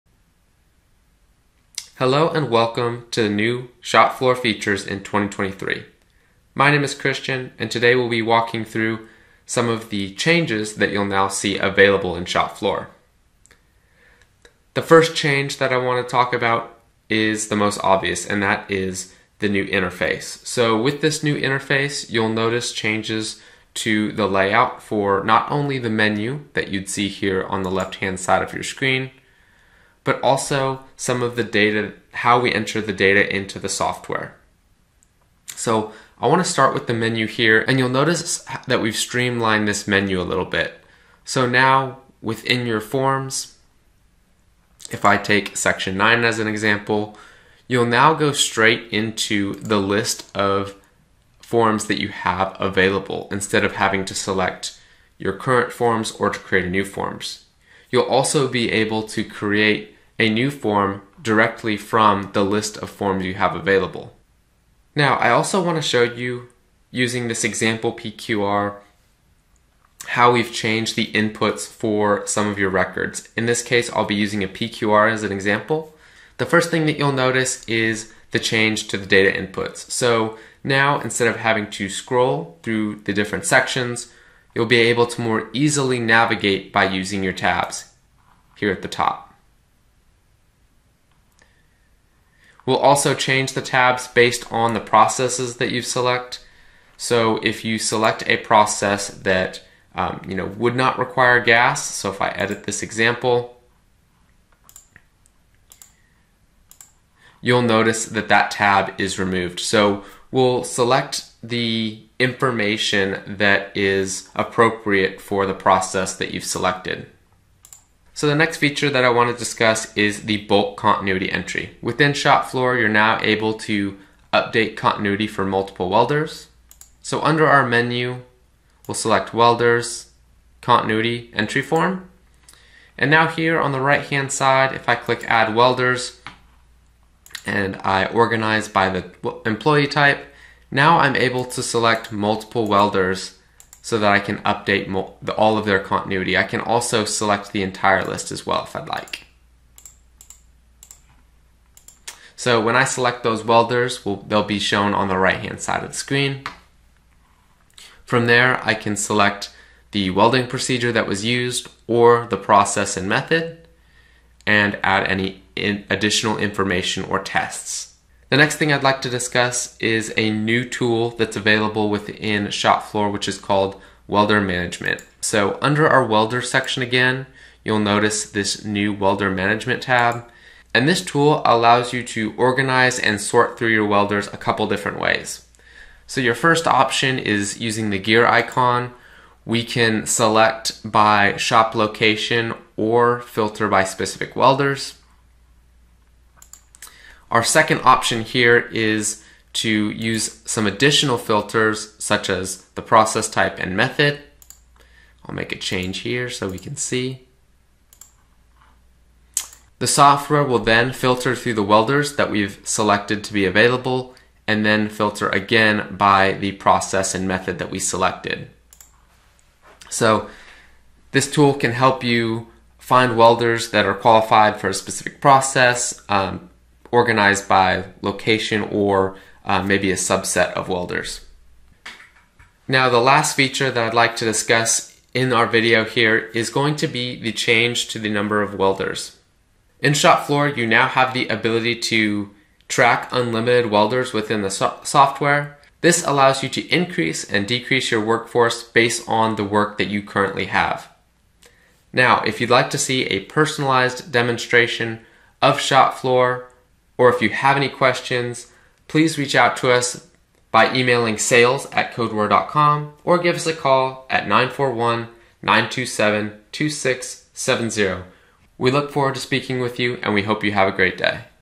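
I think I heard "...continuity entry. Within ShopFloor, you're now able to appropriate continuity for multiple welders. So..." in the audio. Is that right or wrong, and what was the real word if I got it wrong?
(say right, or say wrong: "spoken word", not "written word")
wrong: "update", not "appropriate".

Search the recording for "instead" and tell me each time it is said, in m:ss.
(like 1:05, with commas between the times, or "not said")
0:53, 1:21.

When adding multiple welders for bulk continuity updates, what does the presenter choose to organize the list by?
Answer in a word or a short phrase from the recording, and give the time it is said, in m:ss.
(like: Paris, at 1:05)
Employee type, at 2:19.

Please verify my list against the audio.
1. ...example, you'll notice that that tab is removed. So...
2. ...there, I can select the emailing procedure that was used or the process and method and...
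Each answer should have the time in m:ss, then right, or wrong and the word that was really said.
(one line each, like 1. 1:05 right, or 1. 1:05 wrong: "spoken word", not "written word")
1. 1:42 right
2. 2:38 wrong: "welding", not "emailing".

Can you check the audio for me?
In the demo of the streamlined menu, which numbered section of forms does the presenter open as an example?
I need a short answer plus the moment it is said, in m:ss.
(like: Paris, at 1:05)
Section 9, at 0:45.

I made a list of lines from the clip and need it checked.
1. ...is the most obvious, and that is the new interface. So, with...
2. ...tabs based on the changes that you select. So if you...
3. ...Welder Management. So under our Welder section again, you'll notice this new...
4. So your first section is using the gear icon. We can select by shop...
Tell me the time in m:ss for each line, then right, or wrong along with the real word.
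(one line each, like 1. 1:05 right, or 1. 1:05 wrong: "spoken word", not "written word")
1. 0:17 right
2. 1:33 wrong: "processes", not "changes"
3. 2:54 right
4. 3:06 wrong: "option", not "section".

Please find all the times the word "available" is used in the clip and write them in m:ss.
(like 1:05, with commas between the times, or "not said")
0:11, 0:52, 1:03, 2:51, 3:33.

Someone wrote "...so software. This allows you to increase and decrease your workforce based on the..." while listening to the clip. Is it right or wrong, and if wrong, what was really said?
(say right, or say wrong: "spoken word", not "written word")
right.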